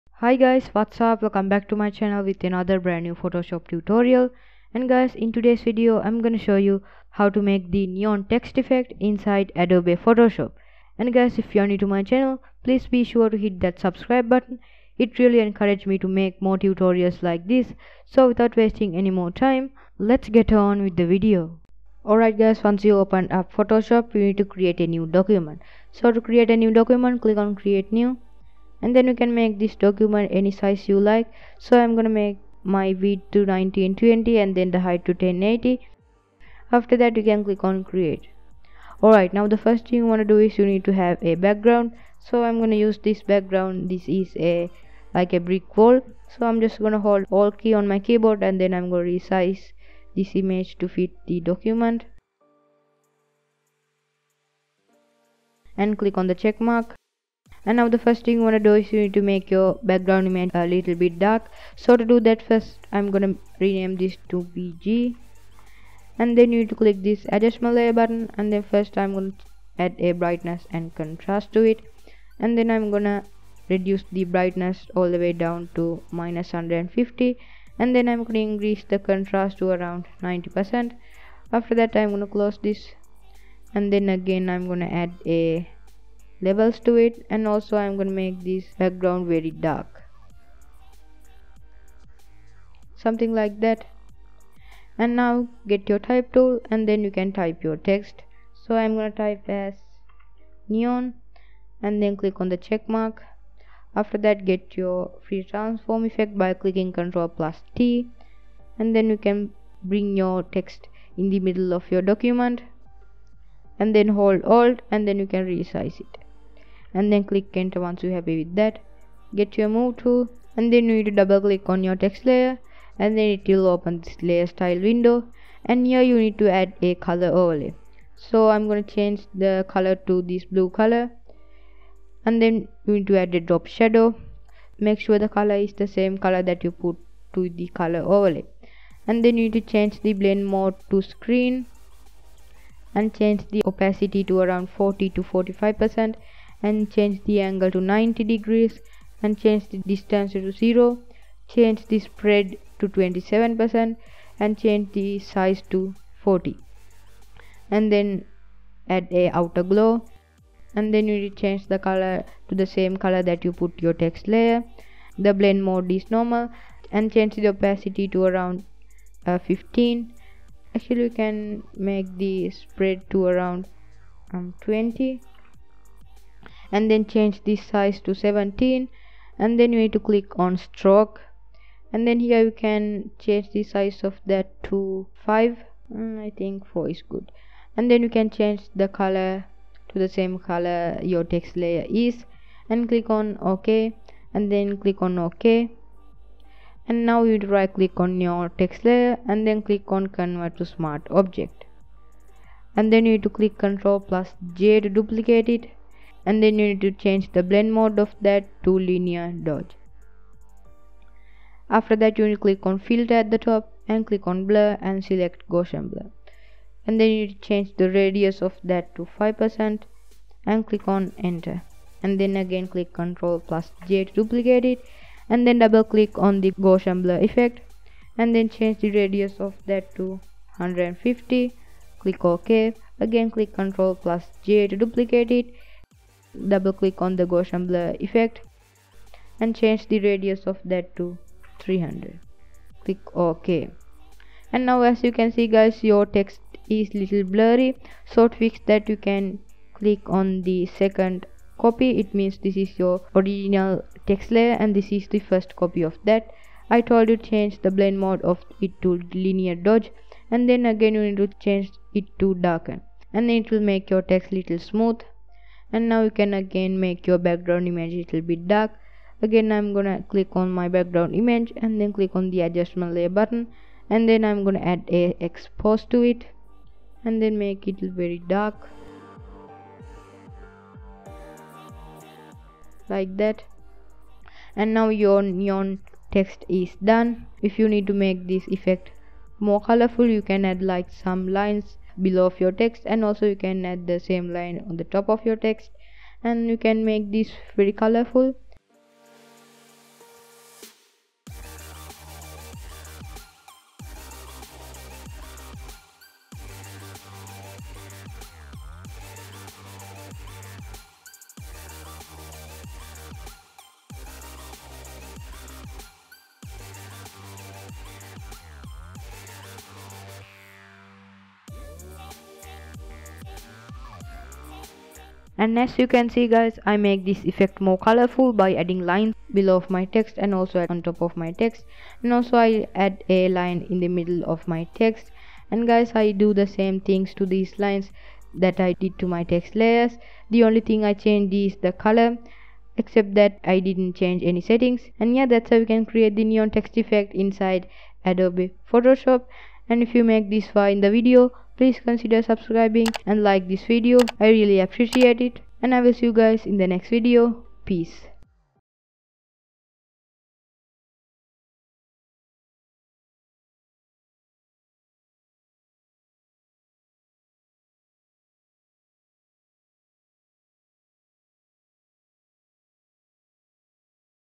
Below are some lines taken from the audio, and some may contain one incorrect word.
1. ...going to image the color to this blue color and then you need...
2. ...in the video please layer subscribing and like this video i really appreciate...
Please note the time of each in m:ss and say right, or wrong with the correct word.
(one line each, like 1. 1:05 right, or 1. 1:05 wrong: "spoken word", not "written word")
1. 2:08 wrong: "change", not "image"
2. 5:50 wrong: "consider", not "layer".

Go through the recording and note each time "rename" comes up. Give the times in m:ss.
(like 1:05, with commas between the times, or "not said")
1:03.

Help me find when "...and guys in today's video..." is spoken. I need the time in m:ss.
0:04.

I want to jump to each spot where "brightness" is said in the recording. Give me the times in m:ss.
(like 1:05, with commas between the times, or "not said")
1:10, 1:14.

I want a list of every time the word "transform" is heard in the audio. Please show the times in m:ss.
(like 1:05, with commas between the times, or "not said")
1:45.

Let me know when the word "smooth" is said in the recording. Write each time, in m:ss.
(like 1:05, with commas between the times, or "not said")
4:24.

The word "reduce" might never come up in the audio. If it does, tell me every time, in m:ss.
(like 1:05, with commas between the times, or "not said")
1:13.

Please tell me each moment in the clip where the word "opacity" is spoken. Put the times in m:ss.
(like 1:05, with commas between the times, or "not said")
2:23, 2:47.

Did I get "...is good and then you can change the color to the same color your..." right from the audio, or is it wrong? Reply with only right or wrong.
right.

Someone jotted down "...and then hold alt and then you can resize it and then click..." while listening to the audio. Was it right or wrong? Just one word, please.
right.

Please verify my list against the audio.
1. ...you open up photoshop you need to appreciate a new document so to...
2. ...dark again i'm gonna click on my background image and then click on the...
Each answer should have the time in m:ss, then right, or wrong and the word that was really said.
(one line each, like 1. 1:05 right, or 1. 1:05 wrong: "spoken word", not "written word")
1. 0:22 wrong: "create", not "appreciate"
2. 4:28 right.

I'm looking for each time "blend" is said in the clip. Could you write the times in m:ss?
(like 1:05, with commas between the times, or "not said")
2:20, 2:45, 3:27, 4:17.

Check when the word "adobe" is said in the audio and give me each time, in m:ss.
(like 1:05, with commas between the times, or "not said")
0:09, 5:48.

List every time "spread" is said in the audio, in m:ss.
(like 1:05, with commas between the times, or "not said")
2:31, 2:52.